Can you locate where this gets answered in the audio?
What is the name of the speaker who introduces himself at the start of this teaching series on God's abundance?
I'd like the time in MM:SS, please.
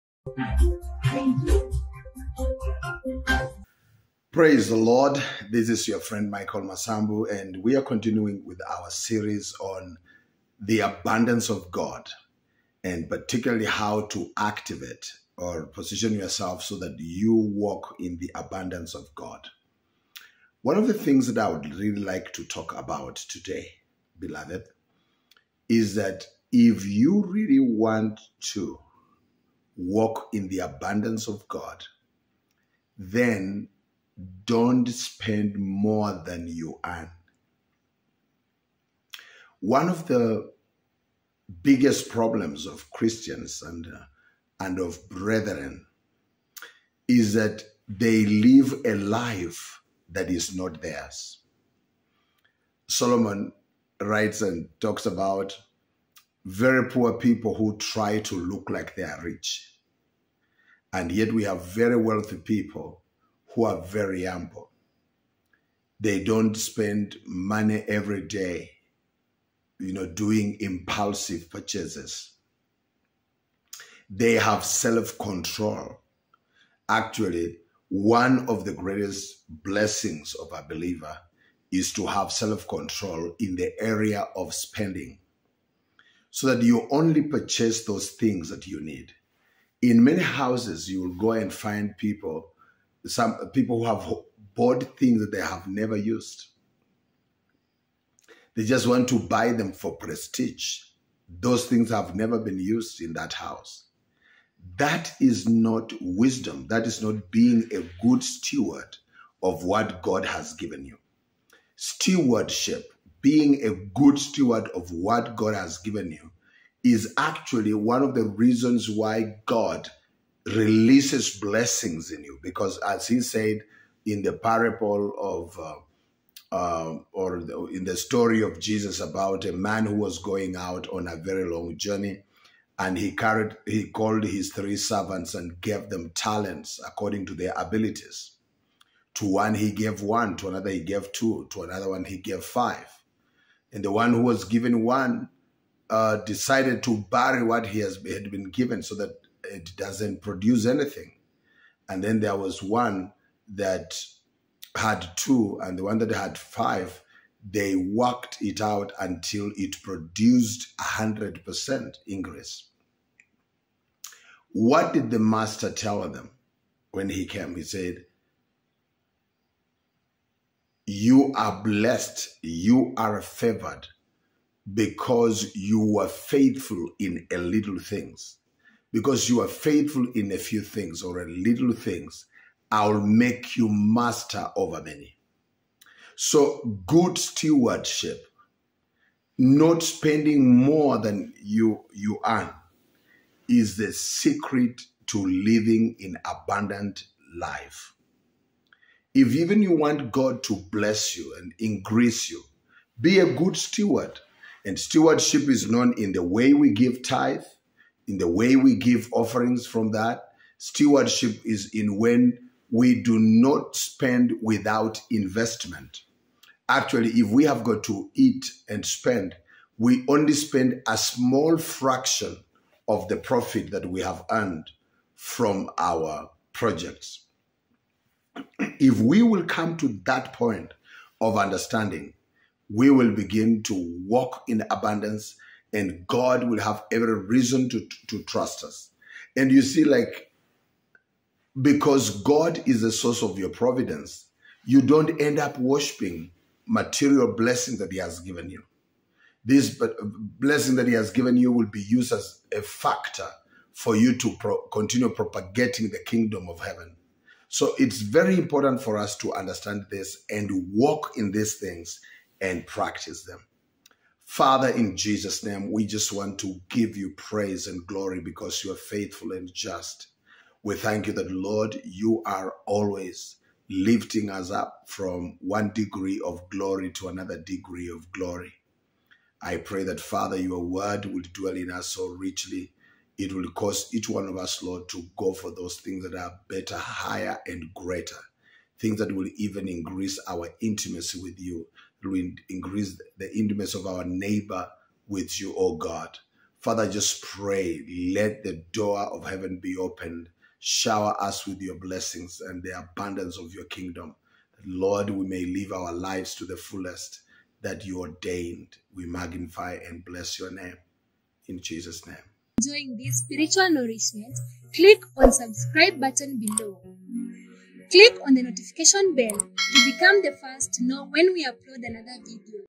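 00:06.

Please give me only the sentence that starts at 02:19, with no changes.
To one he gave one, to another he gave two, to another one he gave five.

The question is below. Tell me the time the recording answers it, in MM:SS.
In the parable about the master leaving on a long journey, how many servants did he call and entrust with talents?
02:14.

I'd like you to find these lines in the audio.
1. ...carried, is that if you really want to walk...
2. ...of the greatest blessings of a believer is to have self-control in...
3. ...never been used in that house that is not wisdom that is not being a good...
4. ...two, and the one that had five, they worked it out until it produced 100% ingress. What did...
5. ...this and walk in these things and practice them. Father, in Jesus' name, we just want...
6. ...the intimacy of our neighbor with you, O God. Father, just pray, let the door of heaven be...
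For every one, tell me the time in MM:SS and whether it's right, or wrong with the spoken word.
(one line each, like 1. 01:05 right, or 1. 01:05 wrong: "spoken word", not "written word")
1. 00:24 wrong: "beloved", not "carried"
2. 01:18 right
3. 01:42 right
4. 02:35 right
5. 04:19 right
6. 04:53 right.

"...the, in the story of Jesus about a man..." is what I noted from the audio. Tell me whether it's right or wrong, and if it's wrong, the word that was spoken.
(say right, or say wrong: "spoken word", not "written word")
right.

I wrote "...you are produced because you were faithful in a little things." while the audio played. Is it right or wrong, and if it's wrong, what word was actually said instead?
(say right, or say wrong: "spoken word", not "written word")
wrong: "favored", not "produced".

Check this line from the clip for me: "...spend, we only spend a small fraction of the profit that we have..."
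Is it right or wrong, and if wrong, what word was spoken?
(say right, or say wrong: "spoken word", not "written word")
right.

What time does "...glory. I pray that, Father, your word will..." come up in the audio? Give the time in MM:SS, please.
04:38.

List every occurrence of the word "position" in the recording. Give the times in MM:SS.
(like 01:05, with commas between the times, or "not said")
00:15.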